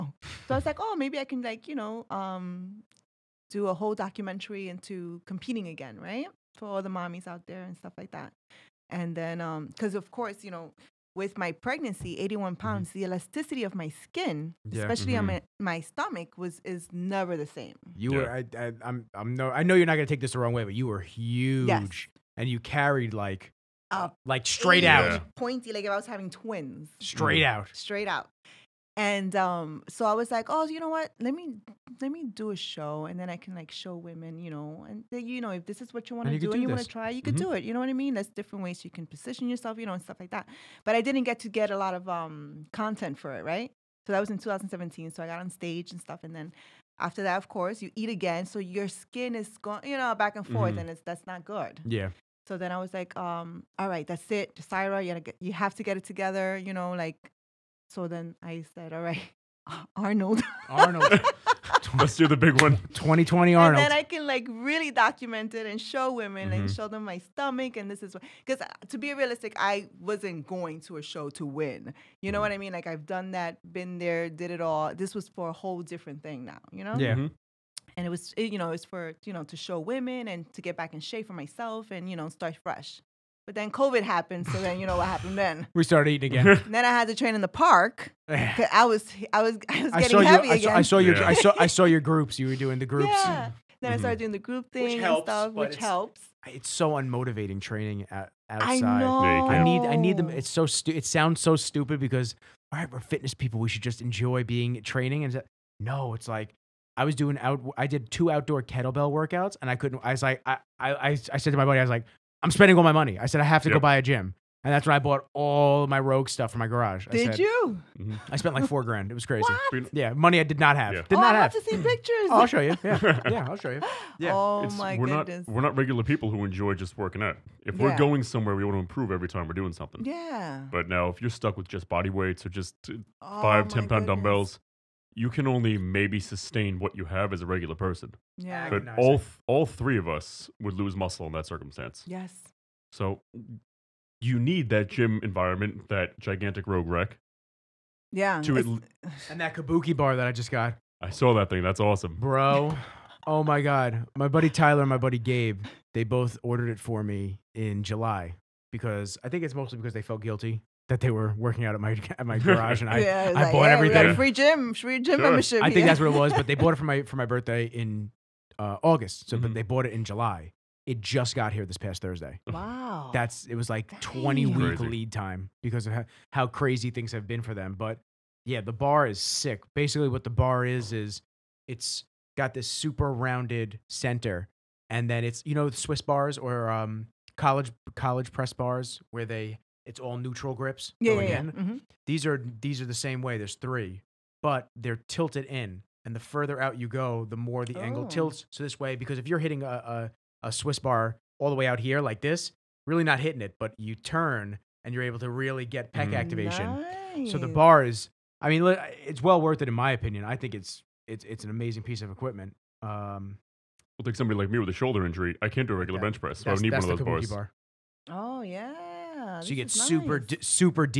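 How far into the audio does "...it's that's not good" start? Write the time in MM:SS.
00:50.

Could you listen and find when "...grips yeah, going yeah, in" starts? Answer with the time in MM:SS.
03:10.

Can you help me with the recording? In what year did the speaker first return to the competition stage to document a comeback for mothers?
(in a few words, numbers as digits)
2017.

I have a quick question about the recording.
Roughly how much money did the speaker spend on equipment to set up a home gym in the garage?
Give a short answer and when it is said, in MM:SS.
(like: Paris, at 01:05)
4 grand, at 01:58.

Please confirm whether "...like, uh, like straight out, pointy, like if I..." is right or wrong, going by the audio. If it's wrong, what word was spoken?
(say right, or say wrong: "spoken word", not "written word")
right.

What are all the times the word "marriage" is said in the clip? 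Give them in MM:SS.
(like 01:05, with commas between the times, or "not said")
not said.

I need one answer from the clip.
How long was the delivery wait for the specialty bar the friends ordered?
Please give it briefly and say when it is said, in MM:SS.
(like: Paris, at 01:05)
20 weeks, at 02:54.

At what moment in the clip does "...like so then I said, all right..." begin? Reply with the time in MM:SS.
00:56.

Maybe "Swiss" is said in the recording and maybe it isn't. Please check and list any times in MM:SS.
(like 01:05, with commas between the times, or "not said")
03:05, 03:20.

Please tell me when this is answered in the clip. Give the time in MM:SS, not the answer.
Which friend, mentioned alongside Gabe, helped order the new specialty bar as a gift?
02:34.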